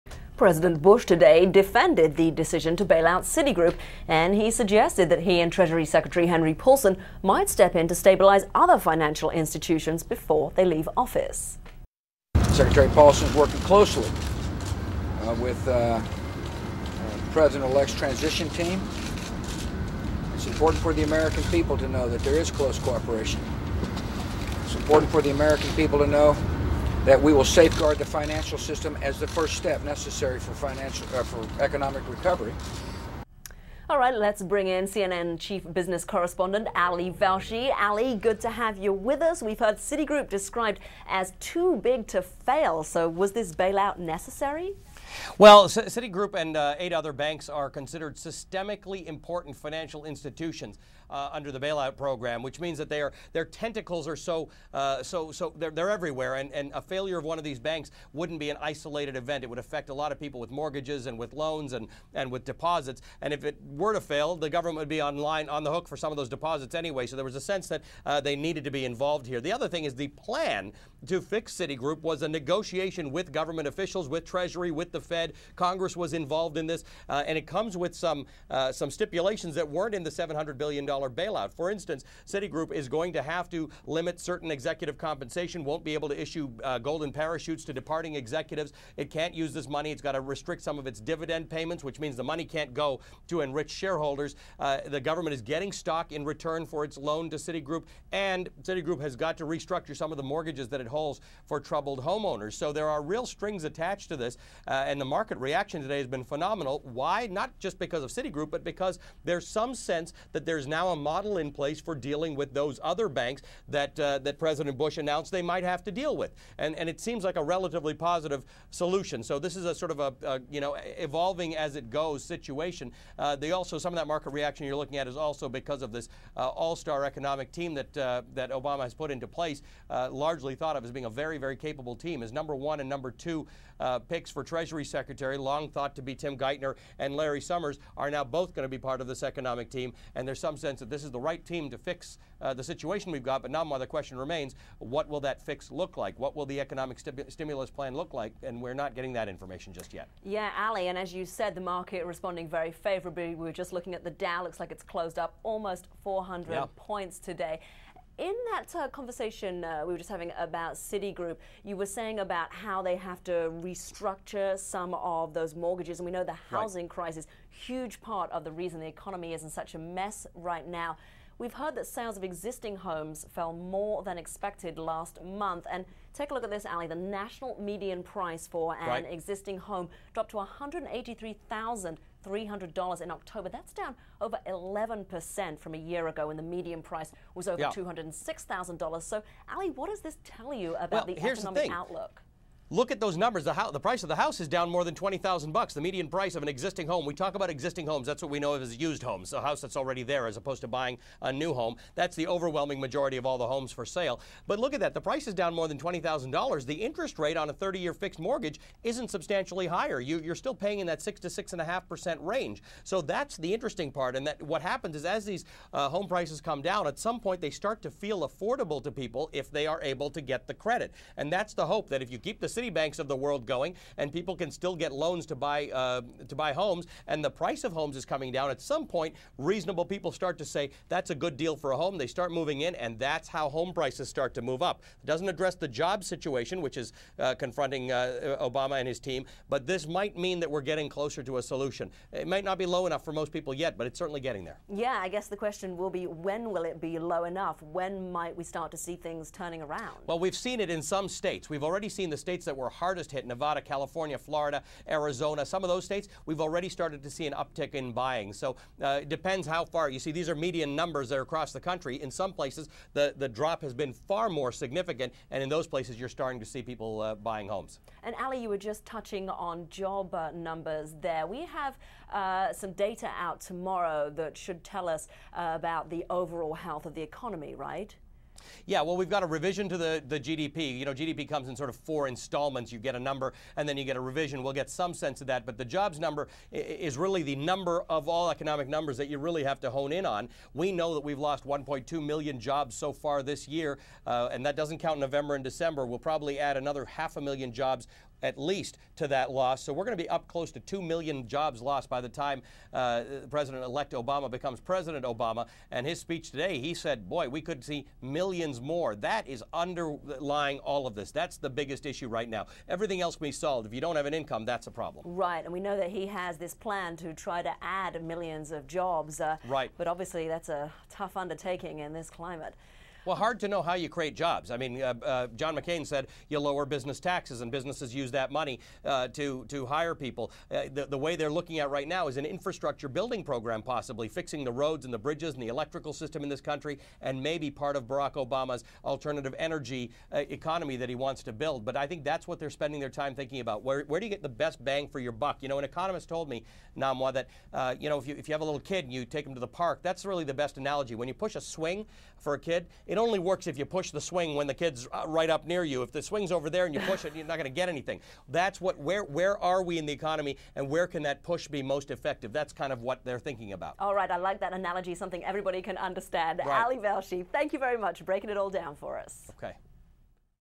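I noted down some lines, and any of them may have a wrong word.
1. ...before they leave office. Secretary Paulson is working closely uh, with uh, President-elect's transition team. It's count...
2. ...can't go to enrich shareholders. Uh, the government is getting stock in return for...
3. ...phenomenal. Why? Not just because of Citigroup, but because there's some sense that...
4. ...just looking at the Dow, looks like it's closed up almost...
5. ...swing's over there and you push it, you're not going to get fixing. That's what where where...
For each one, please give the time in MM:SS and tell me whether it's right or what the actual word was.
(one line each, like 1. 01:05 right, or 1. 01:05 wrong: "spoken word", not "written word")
1. 00:10 wrong: "important", not "count"
2. 01:32 right
3. 01:46 right
4. 02:33 right
5. 05:56 wrong: "anything", not "fixing".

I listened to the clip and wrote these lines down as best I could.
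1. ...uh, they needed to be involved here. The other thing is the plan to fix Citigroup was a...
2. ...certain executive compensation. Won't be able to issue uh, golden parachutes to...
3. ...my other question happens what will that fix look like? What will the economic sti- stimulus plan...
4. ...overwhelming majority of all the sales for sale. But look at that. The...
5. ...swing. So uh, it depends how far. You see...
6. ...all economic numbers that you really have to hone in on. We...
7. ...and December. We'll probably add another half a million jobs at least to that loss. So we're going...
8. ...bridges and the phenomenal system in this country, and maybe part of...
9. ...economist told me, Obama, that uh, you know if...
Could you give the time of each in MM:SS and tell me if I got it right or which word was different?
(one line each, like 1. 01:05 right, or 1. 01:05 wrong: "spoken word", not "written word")
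1. 01:08 right
2. 01:24 right
3. 02:23 wrong: "remains", not "happens"
4. 03:22 wrong: "homes", not "sales"
5. 04:17 wrong: "buying", not "swing"
6. 04:48 right
7. 04:55 right
8. 05:34 wrong: "electrical", not "phenomenal"
9. 05:45 wrong: "Namwa", not "Obama".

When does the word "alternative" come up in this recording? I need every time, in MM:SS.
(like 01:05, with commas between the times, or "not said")
05:38.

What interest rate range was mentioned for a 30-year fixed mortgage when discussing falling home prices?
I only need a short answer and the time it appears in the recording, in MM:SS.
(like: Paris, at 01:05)
6 to 6.5%, at 03:31.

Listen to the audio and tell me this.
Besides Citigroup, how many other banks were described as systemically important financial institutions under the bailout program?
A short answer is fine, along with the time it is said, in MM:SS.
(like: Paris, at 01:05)
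8, at 00:46.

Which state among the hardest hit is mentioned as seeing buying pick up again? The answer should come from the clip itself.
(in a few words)
Nevada.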